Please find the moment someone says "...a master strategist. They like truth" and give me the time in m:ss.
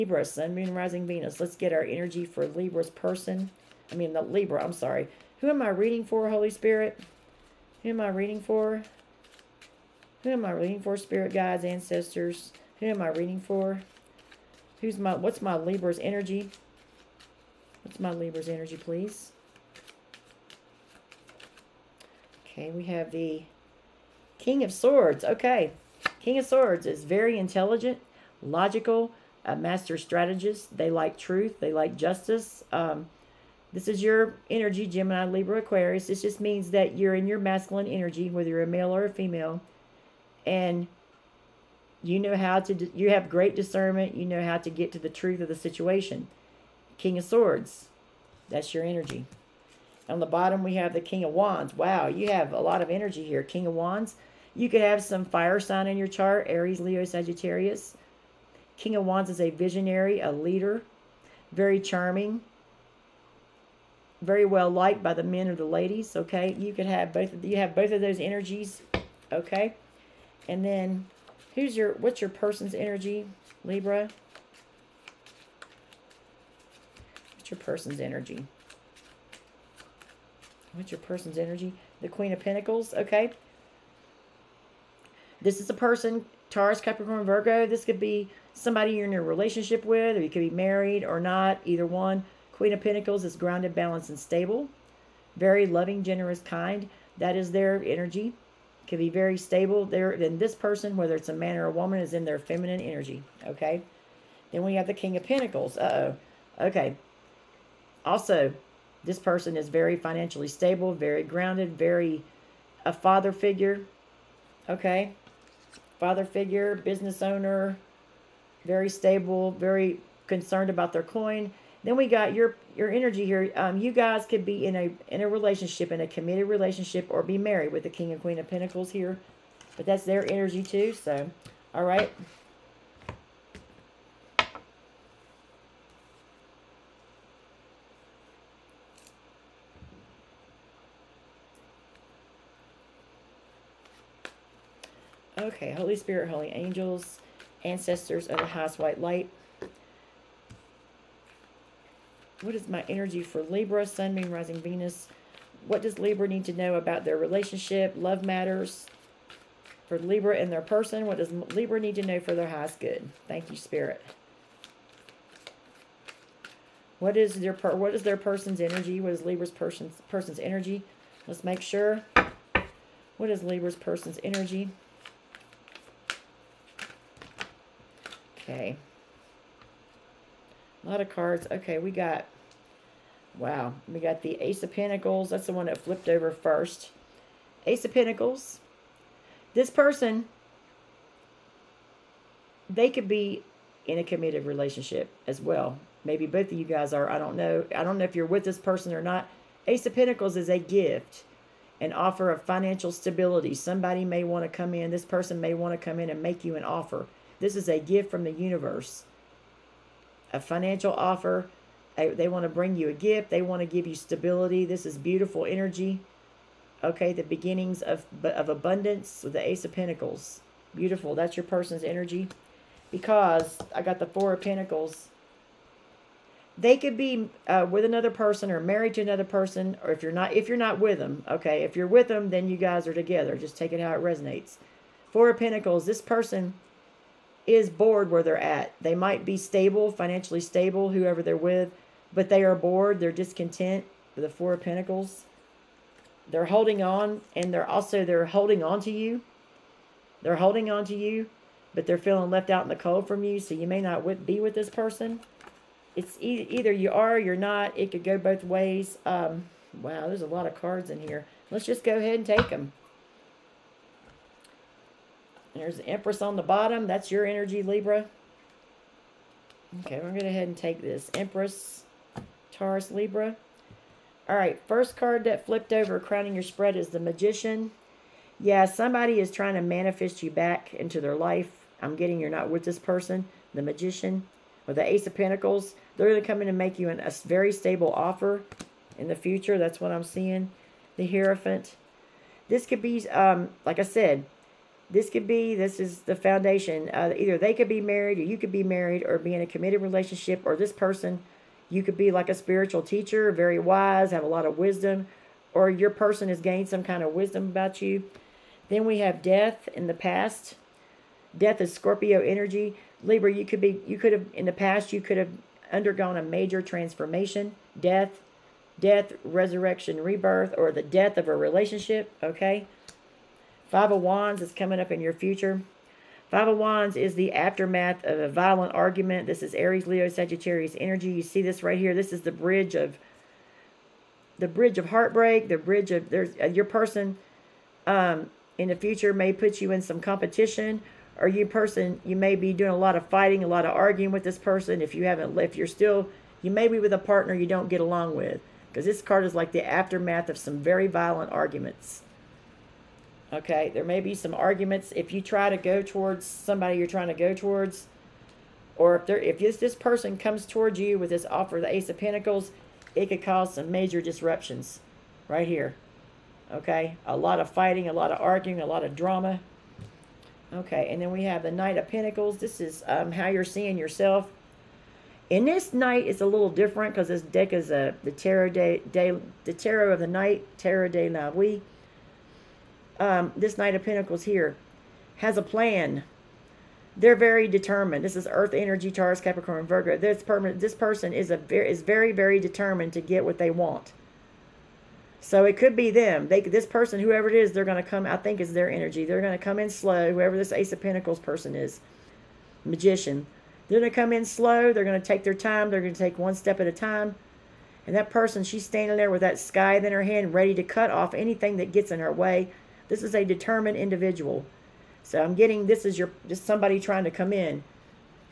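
0:29.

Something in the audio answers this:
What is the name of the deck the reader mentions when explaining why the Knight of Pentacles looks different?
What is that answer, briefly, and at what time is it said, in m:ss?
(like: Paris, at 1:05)
Tarot de la Nuit, at 6:20.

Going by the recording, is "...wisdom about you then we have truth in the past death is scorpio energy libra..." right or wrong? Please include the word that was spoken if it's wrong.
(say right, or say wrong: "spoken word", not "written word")
wrong: "death", not "truth".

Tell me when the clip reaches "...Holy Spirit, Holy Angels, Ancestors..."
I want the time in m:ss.
2:25.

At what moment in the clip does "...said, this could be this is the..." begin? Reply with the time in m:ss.
4:53.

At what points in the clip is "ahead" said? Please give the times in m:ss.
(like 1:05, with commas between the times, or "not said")
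4:21, 4:30.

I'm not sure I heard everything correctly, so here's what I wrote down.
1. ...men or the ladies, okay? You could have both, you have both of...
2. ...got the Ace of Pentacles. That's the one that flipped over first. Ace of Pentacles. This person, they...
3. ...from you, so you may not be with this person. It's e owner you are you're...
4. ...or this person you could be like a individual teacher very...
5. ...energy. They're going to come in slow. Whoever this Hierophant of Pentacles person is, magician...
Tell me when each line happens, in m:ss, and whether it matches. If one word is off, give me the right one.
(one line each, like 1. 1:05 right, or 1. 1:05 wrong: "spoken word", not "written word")
1. 1:05 right
2. 3:03 right
3. 4:13 wrong: "either", not "owner"
4. 5:00 wrong: "spiritual", not "individual"
5. 6:38 wrong: "Ace", not "Hierophant".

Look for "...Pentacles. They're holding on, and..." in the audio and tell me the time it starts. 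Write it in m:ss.
4:04.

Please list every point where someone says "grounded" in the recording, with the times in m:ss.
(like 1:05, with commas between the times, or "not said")
1:33, 1:51.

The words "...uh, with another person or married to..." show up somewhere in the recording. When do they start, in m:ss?
3:47.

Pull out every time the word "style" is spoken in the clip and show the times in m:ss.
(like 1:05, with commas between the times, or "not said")
not said.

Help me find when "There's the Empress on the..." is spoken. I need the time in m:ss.
4:25.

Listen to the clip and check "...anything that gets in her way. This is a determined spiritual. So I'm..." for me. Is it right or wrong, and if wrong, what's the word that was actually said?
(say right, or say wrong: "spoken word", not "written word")
wrong: "individual", not "spiritual".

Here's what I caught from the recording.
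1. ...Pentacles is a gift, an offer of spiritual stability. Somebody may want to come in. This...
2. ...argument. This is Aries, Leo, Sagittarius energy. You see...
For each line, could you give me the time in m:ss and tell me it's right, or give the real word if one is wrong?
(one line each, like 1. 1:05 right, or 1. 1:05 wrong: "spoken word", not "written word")
1. 3:19 wrong: "financial", not "spiritual"
2. 5:28 right.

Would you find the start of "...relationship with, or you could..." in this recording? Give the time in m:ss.
1:29.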